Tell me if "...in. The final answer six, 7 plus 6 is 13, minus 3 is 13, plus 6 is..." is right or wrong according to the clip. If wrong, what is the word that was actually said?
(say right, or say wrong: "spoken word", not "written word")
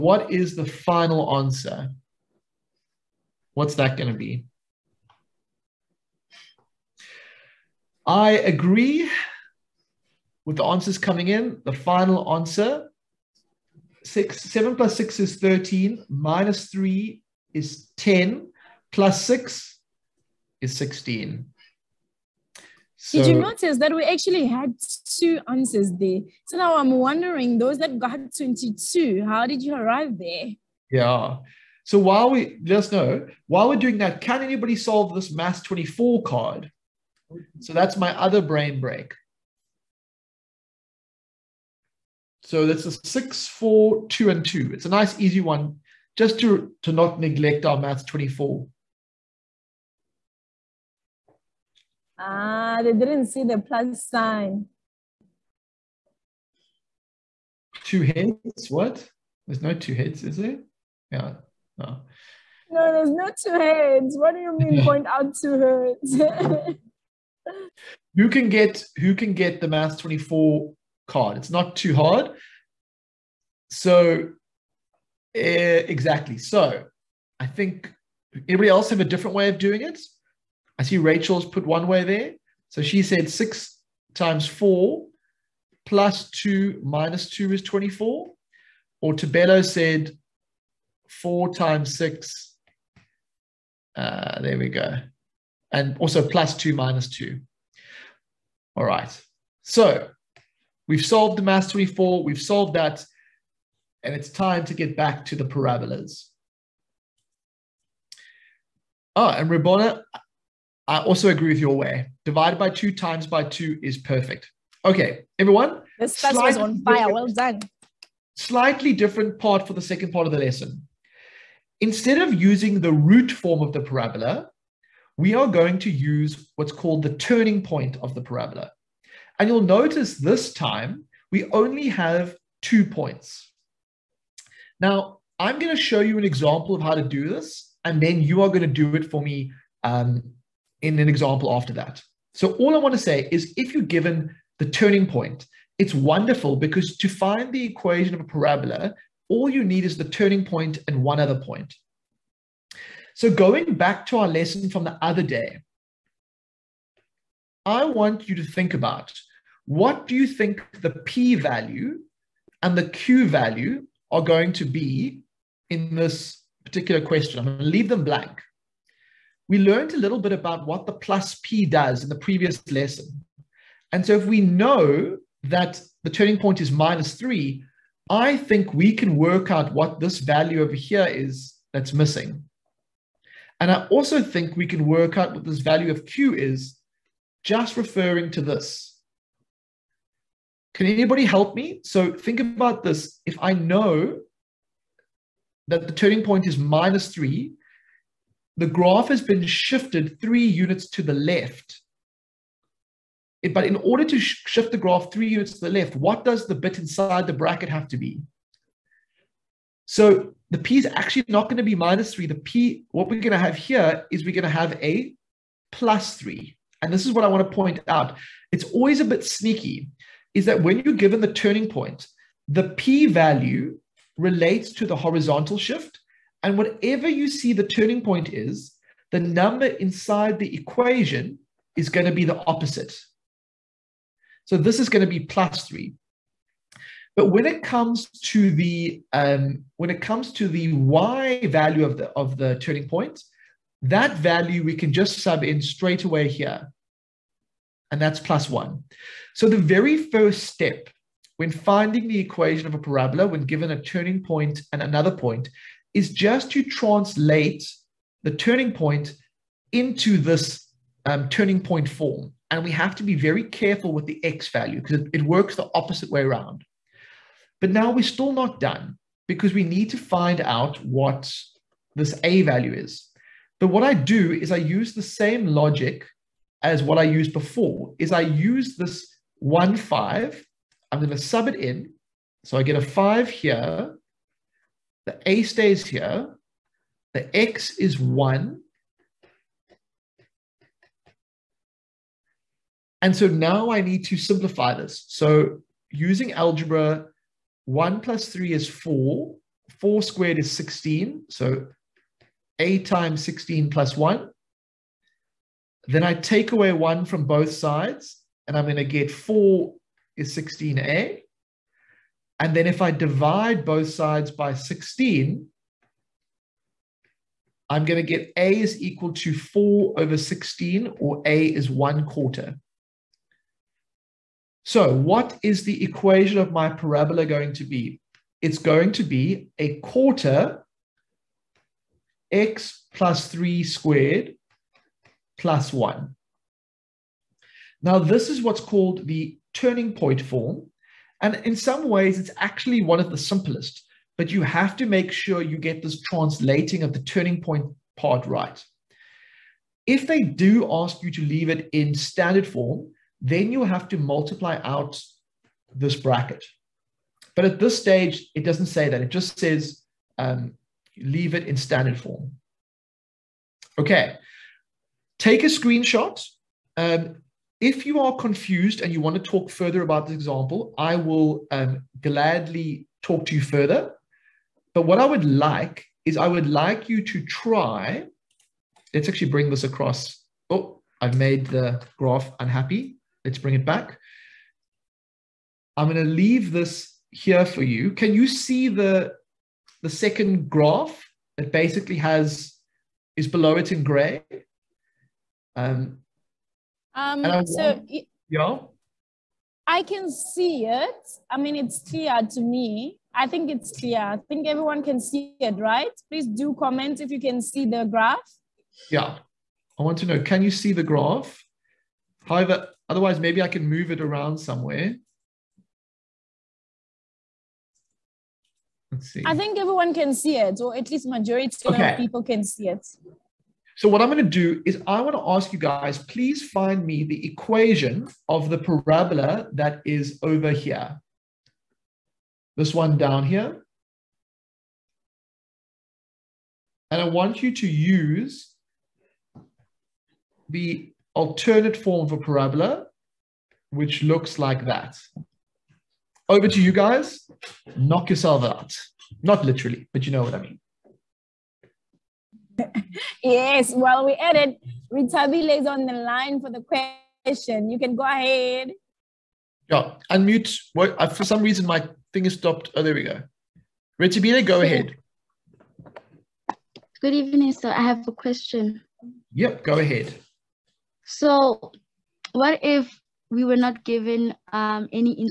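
wrong: "10", not "13".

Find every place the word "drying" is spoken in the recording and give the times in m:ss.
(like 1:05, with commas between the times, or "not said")
not said.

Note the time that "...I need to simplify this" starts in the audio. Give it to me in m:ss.
4:53.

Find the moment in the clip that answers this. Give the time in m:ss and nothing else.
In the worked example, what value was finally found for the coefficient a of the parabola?
5:21.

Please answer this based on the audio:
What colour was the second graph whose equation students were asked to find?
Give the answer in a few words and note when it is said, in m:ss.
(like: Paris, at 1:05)
gray, at 6:33.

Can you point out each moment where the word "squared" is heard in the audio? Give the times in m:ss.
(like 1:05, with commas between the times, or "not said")
5:00, 5:33.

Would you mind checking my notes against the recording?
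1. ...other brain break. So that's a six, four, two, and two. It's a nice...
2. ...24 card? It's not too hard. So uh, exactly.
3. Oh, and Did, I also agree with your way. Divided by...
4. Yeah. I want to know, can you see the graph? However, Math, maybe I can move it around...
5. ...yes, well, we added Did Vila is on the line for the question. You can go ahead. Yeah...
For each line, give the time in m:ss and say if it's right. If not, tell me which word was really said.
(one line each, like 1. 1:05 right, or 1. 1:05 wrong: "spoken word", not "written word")
1. 0:38 right
2. 1:09 right
3. 1:49 wrong: "Ribona", not "Did"
4. 6:48 wrong: "Otherwise", not "Math"
5. 7:33 wrong: "Rita", not "Did".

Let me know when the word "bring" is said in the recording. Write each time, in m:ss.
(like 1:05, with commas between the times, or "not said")
6:19, 6:23.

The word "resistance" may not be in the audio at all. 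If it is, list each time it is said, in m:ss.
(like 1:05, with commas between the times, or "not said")
not said.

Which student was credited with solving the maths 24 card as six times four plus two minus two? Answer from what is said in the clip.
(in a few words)
Rachel.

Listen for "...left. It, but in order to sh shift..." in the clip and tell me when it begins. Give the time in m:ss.
3:21.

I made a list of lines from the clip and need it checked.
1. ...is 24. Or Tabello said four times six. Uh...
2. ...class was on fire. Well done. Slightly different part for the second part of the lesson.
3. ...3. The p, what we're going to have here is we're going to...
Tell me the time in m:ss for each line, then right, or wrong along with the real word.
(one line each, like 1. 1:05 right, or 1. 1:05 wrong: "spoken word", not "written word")
1. 1:27 right
2. 1:56 right
3. 3:32 right.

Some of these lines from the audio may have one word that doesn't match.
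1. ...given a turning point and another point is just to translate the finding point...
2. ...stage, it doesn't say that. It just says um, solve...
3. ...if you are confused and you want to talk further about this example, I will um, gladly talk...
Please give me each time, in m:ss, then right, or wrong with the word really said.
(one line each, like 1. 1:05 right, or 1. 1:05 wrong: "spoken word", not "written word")
1. 4:13 wrong: "turning", not "finding"
2. 5:57 wrong: "leave", not "solve"
3. 6:07 right.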